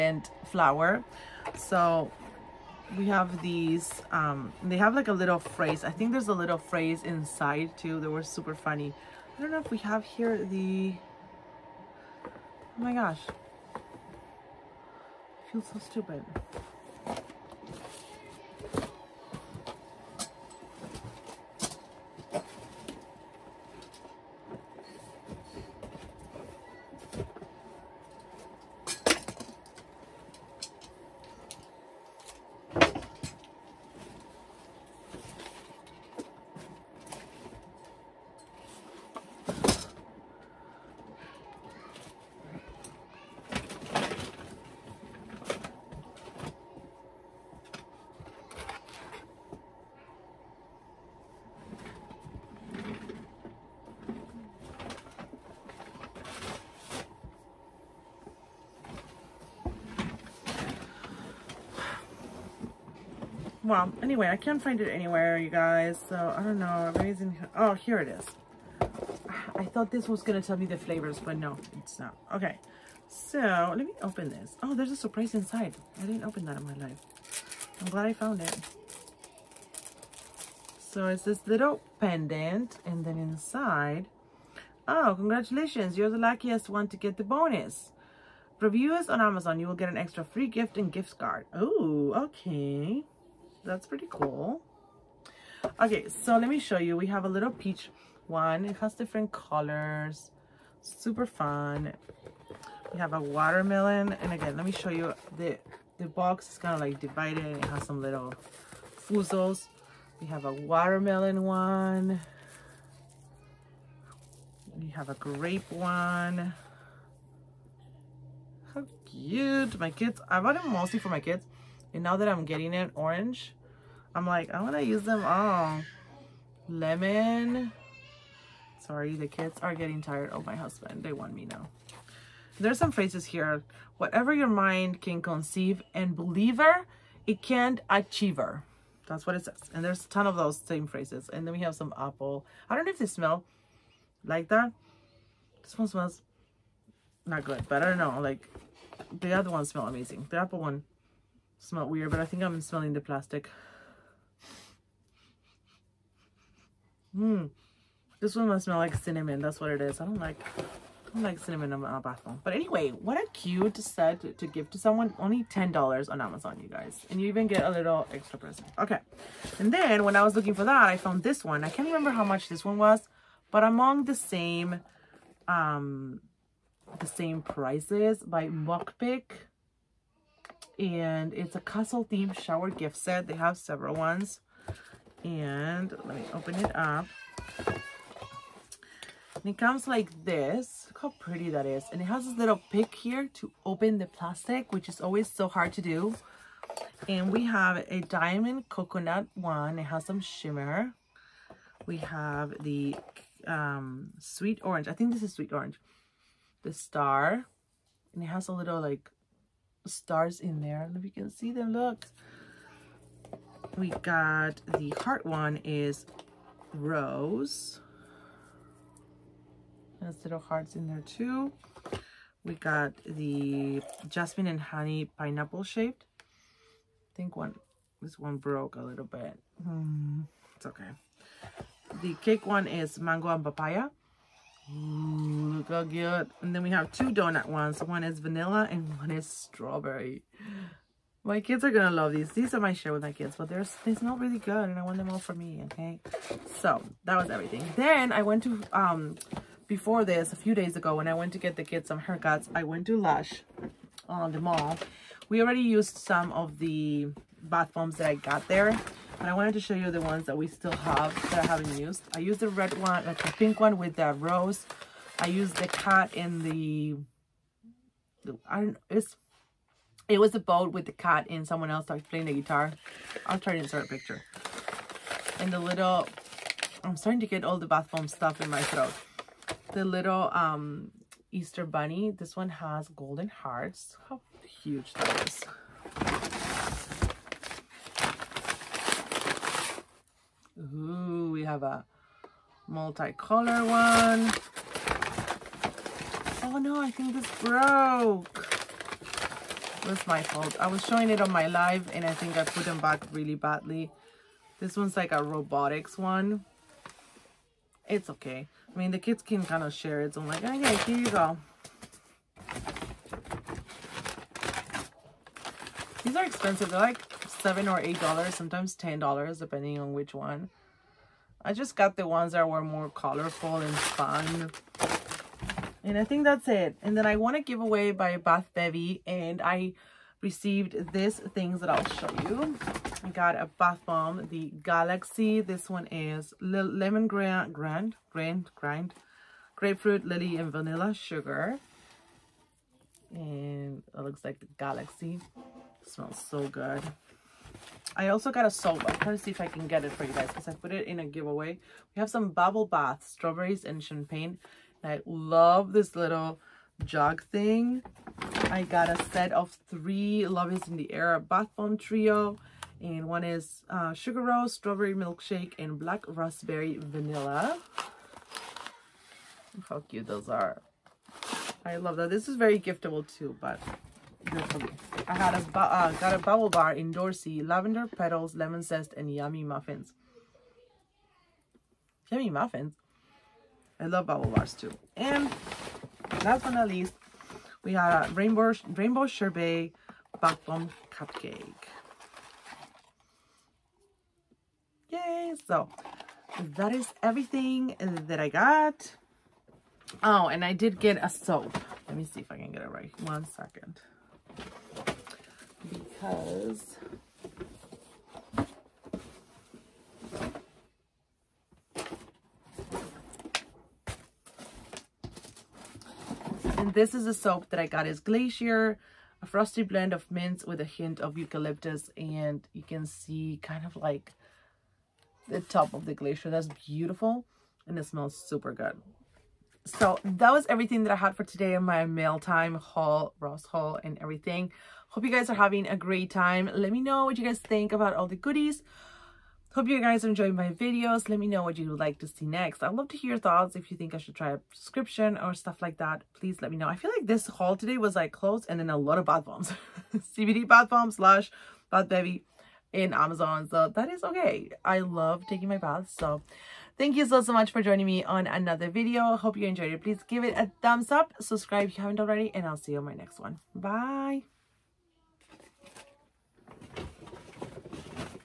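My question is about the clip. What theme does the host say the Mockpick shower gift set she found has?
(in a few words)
castle.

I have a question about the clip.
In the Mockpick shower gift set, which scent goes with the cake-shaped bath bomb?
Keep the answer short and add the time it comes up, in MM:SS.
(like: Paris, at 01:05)
mango and papaya, at 03:52.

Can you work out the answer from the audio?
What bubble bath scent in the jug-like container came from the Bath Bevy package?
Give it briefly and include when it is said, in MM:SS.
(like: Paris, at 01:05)
strawberries and champagne, at 05:53.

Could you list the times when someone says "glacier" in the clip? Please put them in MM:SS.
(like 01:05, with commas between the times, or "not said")
06:58, 07:05.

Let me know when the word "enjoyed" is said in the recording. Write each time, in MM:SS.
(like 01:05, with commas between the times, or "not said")
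07:20, 07:39.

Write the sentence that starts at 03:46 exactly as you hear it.
I think one this one broke a little bit.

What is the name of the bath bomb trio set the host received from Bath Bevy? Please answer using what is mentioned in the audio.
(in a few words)
Love is in the Air.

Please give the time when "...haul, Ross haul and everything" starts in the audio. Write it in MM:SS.
07:12.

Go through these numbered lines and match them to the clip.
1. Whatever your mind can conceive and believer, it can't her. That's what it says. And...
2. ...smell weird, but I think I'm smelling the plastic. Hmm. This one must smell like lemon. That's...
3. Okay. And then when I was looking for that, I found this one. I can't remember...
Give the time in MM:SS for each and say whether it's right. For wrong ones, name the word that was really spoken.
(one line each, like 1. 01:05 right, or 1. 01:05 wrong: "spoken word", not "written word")
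1. 02:13 right
2. 02:31 wrong: "cinnamon", not "lemon"
3. 02:48 right.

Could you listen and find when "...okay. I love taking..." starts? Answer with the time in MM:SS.
07:34.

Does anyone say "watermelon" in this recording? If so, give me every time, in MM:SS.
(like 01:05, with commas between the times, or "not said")
01:43, 01:50.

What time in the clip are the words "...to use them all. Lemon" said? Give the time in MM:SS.
02:04.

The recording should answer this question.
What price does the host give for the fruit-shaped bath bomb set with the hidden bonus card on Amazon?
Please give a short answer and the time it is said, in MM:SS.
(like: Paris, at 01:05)
$10, at 02:45.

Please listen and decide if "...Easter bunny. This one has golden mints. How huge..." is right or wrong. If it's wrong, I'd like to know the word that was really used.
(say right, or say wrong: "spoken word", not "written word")
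wrong: "hearts", not "mints".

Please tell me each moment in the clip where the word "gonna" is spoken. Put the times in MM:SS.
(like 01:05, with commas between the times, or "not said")
01:10, 04:01.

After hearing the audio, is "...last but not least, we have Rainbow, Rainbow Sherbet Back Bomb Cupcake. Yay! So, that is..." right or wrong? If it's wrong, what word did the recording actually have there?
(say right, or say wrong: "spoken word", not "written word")
right.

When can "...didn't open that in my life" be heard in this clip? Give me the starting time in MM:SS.
01:16.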